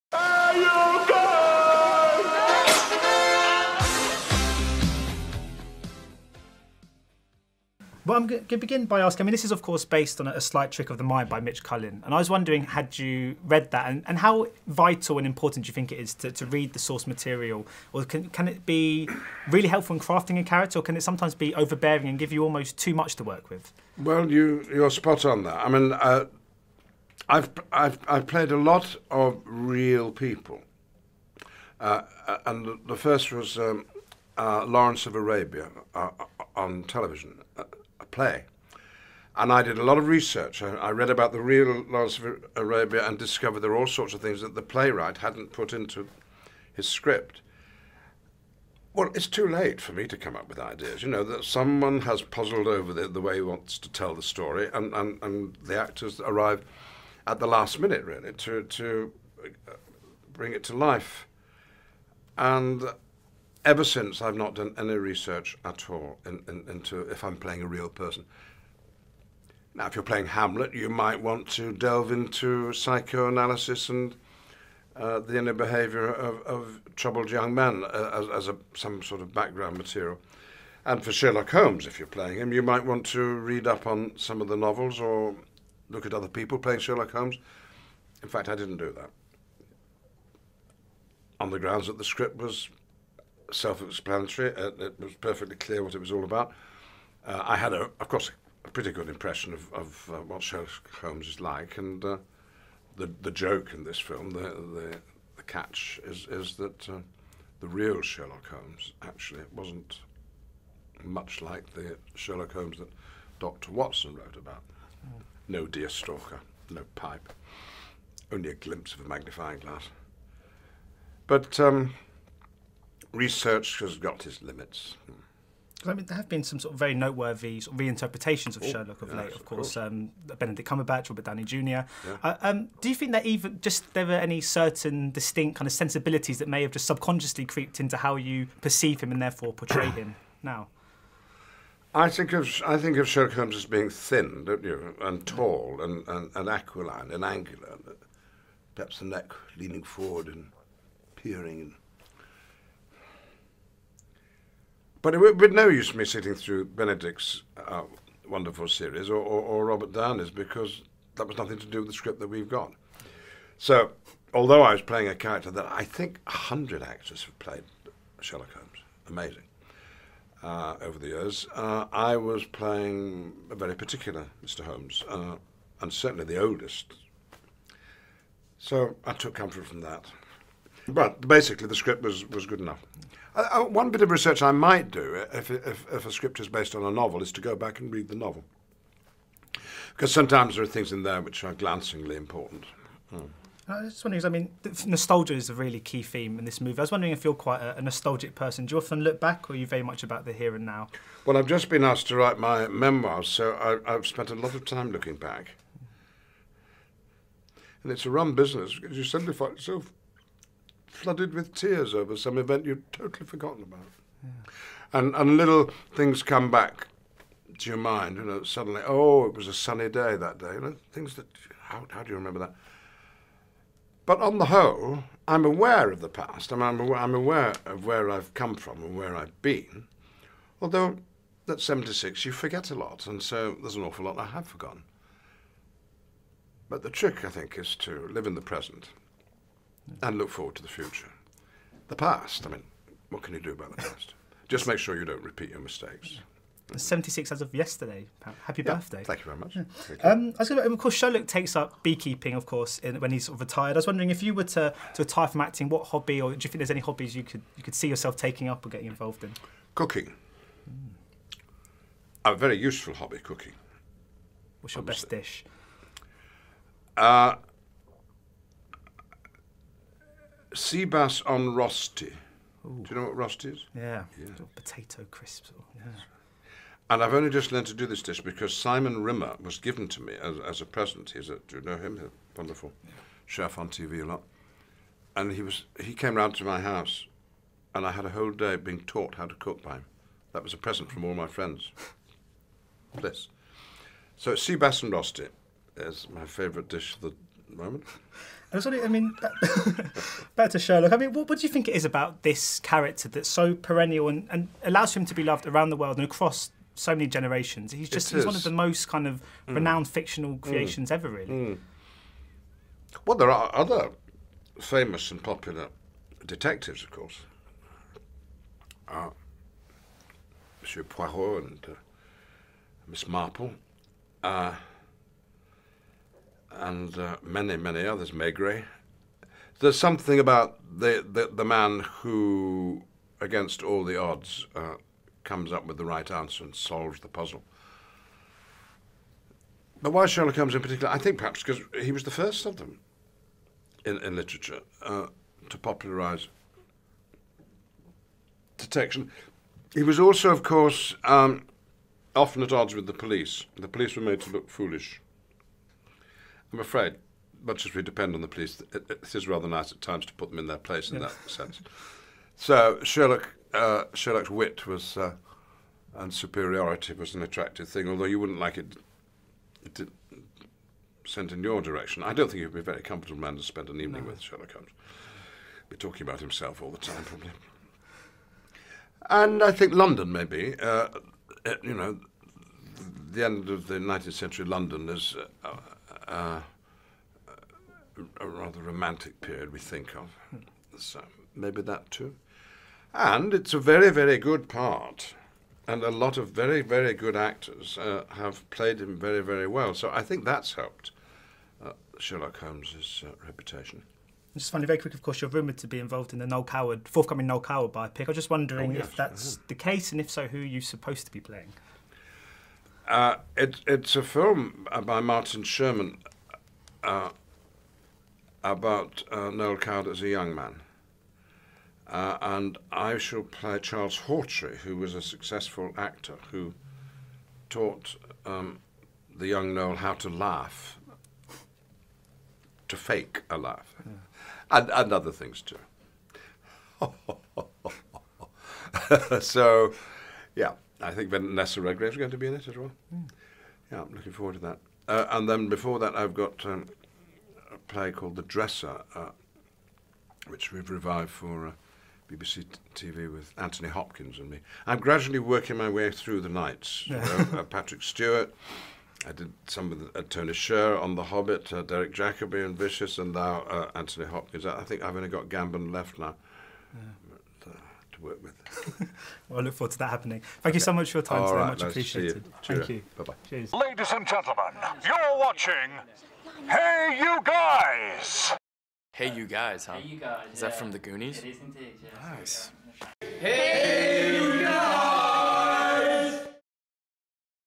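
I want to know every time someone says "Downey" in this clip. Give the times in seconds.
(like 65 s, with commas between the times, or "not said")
131 s, 159 s.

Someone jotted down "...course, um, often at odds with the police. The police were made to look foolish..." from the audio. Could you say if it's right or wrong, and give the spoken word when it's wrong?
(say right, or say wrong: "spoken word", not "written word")
right.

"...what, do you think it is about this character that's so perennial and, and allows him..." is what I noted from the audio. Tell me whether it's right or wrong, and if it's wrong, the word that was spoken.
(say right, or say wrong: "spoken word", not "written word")
right.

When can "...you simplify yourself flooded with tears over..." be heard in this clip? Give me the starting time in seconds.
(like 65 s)
208 s.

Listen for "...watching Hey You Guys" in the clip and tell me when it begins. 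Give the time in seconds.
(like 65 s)
475 s.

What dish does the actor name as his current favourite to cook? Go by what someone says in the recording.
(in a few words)
Sea bass on rosti.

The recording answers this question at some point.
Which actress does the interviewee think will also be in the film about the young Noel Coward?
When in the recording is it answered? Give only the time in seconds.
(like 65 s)
441 s.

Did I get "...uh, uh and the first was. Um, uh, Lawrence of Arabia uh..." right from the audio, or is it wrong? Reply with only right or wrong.
right.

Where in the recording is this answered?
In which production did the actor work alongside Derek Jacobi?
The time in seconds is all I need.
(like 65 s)
462 s.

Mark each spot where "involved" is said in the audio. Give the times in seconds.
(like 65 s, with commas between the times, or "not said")
258 s, 405 s.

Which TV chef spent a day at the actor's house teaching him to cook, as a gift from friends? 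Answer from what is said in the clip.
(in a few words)
Simon Rimmer.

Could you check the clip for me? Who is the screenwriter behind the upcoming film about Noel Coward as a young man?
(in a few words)
Martin Sherman.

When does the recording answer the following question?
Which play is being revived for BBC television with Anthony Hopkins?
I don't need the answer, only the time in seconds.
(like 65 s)
448 s.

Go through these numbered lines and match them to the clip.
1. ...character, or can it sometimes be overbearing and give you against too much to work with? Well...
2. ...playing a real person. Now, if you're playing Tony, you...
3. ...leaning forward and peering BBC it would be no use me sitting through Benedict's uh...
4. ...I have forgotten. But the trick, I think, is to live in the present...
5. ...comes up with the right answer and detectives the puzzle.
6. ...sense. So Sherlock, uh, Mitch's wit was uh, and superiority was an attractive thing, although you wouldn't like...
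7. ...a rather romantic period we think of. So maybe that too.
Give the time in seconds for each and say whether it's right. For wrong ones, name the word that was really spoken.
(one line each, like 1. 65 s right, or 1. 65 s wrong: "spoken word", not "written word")
1. 20 s wrong: "almost", not "against"
2. 67 s wrong: "Hamlet", not "Tony"
3. 149 s wrong: "But", not "BBC"
4. 234 s right
5. 335 s wrong: "solves", not "detectives"
6. 361 s wrong: "Sherlock", not "Mitch"
7. 388 s right.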